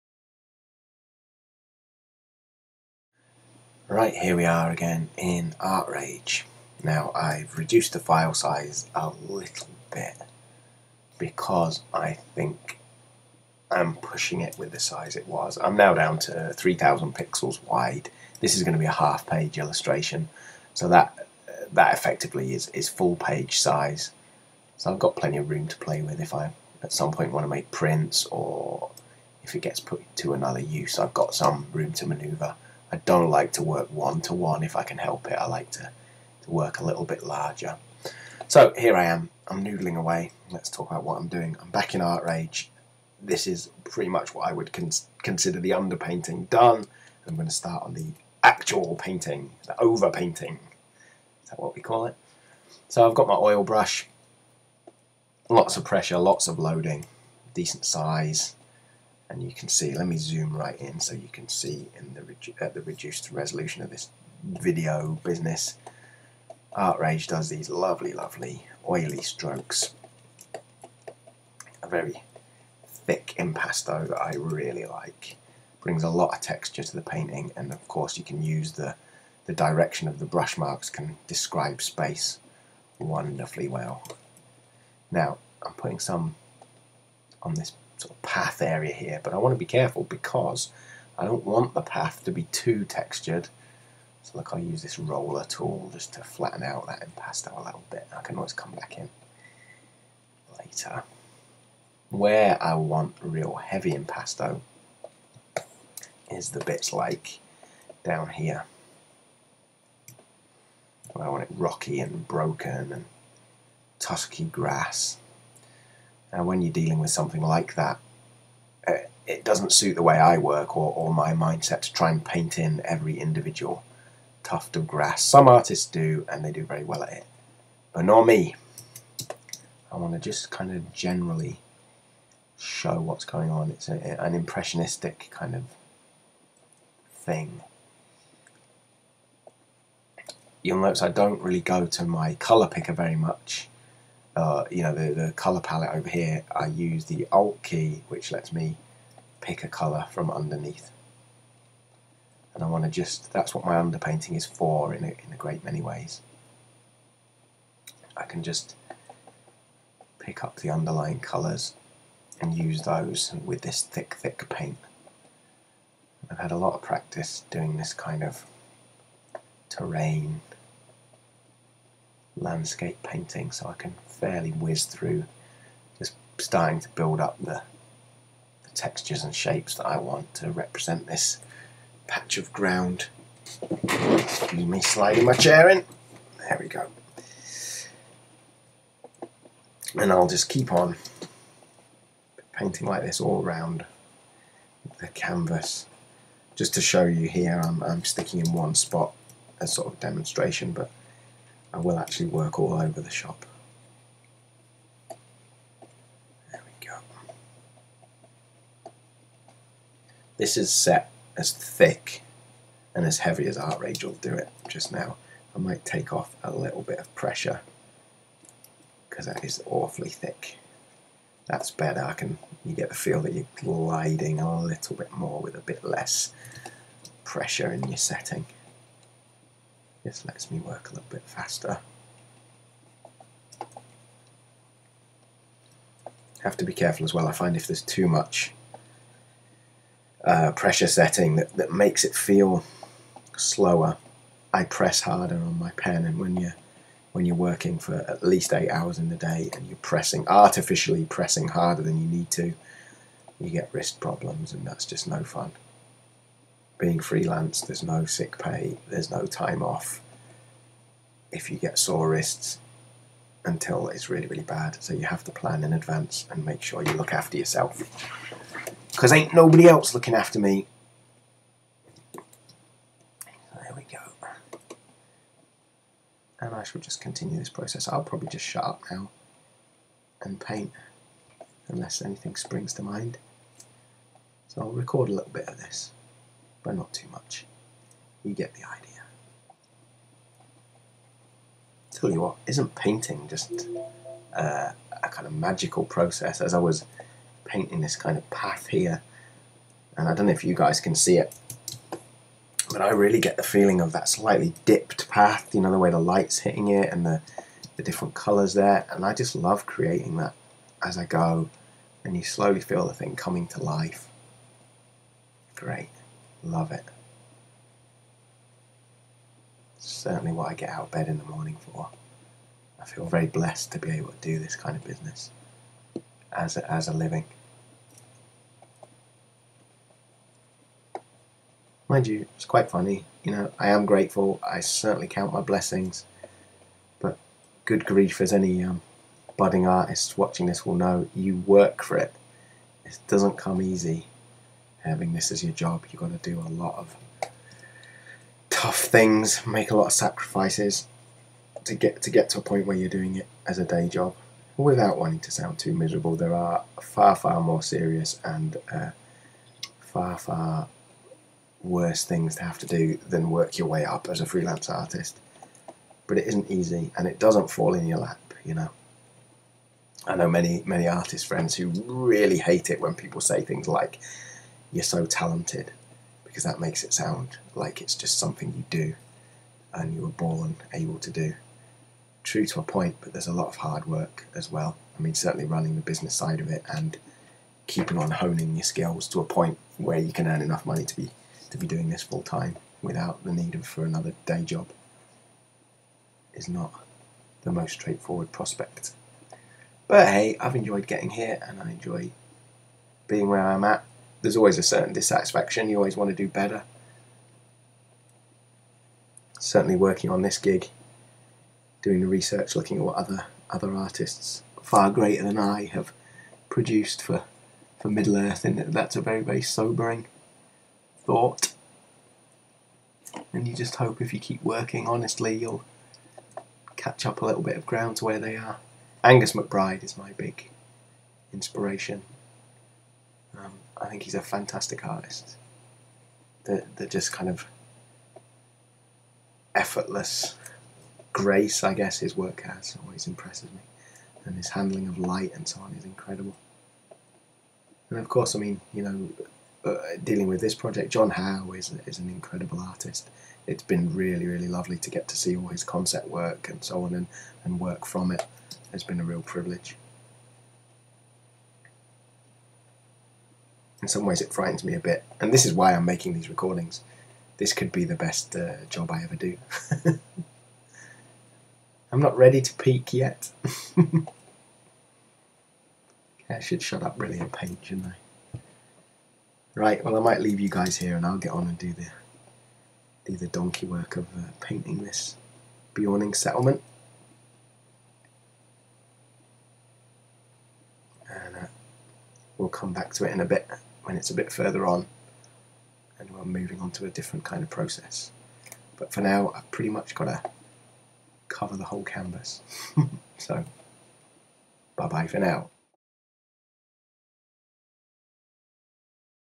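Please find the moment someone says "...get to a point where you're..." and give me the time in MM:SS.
05:52.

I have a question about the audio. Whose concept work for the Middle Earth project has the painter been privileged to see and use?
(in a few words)
John Howe.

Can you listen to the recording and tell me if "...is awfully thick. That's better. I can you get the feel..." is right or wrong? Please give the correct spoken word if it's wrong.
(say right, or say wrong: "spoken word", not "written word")
right.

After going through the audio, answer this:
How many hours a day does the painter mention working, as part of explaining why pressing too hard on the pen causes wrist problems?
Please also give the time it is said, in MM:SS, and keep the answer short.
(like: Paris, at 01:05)
eight, at 04:08.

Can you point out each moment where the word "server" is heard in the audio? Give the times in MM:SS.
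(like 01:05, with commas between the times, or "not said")
not said.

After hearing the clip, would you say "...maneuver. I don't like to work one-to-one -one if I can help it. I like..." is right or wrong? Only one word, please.
right.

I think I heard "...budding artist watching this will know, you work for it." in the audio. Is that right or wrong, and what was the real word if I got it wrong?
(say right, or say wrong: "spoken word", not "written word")
right.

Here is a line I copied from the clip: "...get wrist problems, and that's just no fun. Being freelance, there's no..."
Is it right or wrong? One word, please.
right.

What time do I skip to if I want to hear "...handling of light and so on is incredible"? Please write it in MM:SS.
07:24.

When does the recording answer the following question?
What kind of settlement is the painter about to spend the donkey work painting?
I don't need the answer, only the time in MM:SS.
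08:05.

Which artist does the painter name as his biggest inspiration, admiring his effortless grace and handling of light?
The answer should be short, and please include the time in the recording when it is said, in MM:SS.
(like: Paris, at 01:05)
Angus McBride, at 07:09.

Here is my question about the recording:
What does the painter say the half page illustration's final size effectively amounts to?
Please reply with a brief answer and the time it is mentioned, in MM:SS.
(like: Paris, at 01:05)
full page size, at 00:22.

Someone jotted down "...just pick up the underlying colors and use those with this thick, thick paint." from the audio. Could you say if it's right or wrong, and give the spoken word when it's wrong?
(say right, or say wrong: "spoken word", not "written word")
right.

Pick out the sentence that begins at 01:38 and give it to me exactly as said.
I can always come back in later.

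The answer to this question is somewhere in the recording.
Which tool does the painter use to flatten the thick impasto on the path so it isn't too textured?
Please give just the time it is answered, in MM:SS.
01:34.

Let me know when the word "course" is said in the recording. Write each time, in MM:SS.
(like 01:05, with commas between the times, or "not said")
01:17, 07:28.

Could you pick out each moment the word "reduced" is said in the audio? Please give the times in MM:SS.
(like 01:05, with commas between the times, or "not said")
00:07, 01:02.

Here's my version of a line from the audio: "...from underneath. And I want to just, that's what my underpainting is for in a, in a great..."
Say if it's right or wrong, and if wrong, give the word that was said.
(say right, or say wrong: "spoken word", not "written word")
right.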